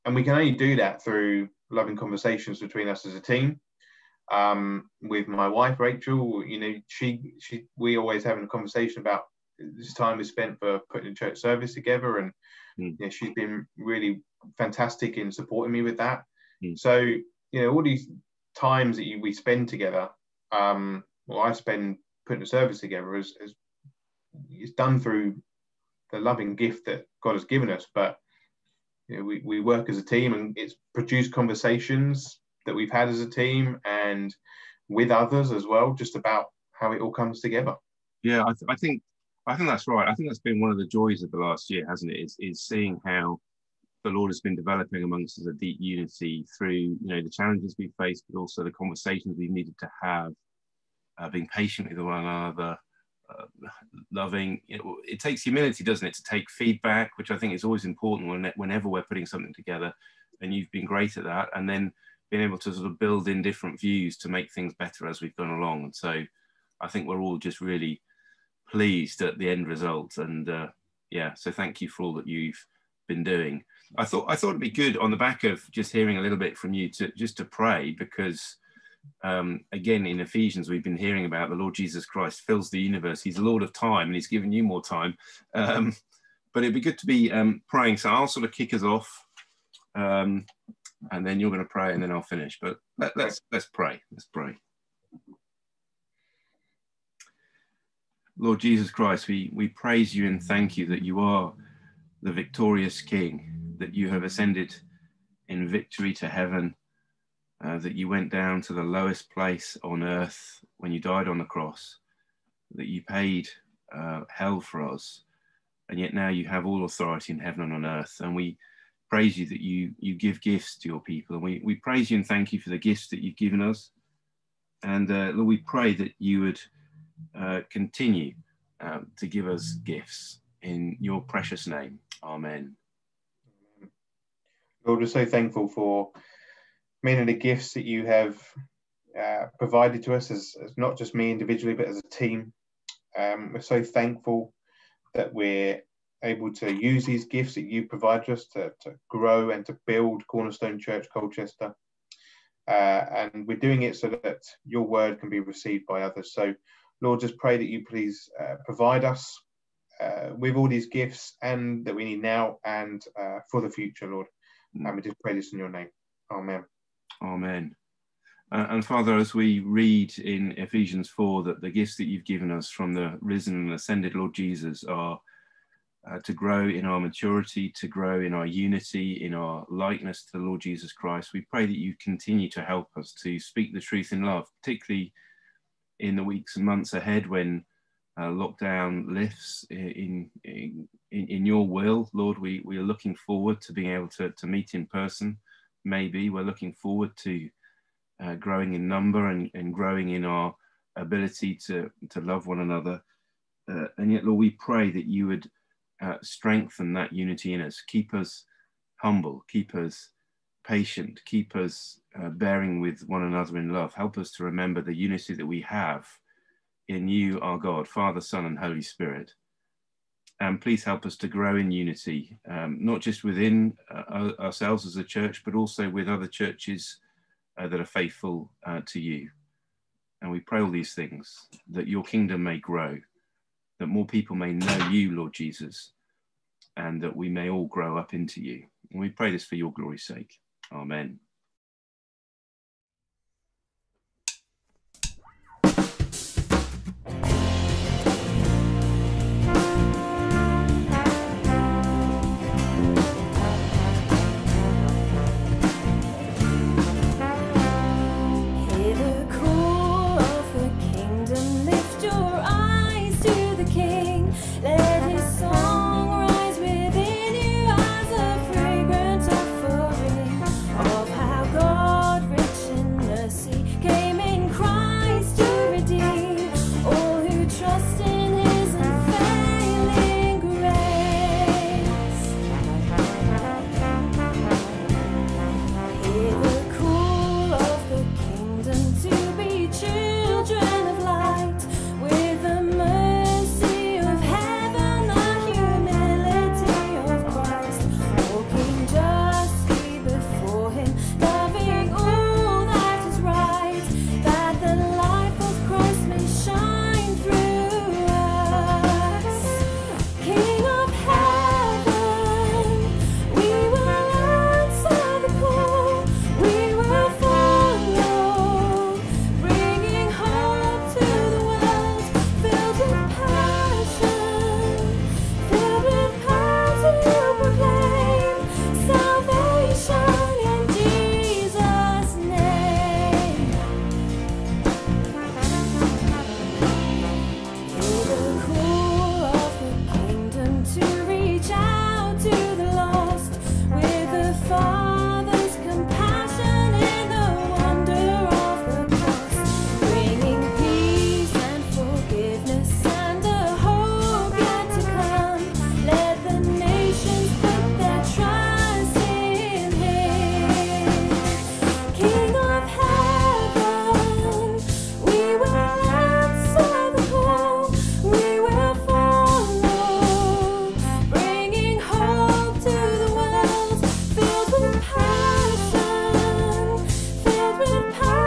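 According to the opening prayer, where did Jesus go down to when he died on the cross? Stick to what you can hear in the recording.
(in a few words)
The lowest place on earth.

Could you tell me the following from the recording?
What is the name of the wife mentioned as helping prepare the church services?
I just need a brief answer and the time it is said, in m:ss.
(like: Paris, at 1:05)
Rachel, at 0:05.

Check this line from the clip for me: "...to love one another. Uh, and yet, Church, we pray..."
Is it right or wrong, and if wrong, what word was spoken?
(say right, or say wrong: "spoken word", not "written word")
wrong: "Lord", not "Church".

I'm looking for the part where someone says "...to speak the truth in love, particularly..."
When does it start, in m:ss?
3:03.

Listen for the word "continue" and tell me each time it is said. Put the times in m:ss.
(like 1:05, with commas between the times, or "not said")
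2:07, 3:02.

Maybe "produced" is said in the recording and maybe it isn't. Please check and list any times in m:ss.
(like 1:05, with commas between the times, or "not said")
0:30.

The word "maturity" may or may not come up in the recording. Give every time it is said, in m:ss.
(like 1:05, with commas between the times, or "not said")
2:57.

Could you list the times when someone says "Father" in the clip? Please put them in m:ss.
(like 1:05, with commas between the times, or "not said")
2:48, 3:37.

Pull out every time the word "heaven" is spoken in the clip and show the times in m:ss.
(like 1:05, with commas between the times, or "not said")
1:46, 1:57.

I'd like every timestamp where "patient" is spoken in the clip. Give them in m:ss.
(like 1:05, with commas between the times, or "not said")
0:51, 3:30.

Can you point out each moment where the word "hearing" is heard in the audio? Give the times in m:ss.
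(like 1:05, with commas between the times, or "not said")
1:15, 1:20.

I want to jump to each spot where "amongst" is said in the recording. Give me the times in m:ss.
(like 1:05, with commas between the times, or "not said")
0:45.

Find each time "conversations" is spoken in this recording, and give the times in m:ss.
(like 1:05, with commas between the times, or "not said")
0:01, 0:08, 0:31, 0:48.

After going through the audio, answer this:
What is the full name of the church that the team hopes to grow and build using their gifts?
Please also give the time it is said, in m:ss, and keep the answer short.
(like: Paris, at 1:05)
Cornerstone Church Colchester, at 2:30.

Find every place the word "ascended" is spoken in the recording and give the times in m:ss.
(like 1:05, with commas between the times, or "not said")
1:44, 2:53.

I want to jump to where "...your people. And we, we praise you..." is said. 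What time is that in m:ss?
2:00.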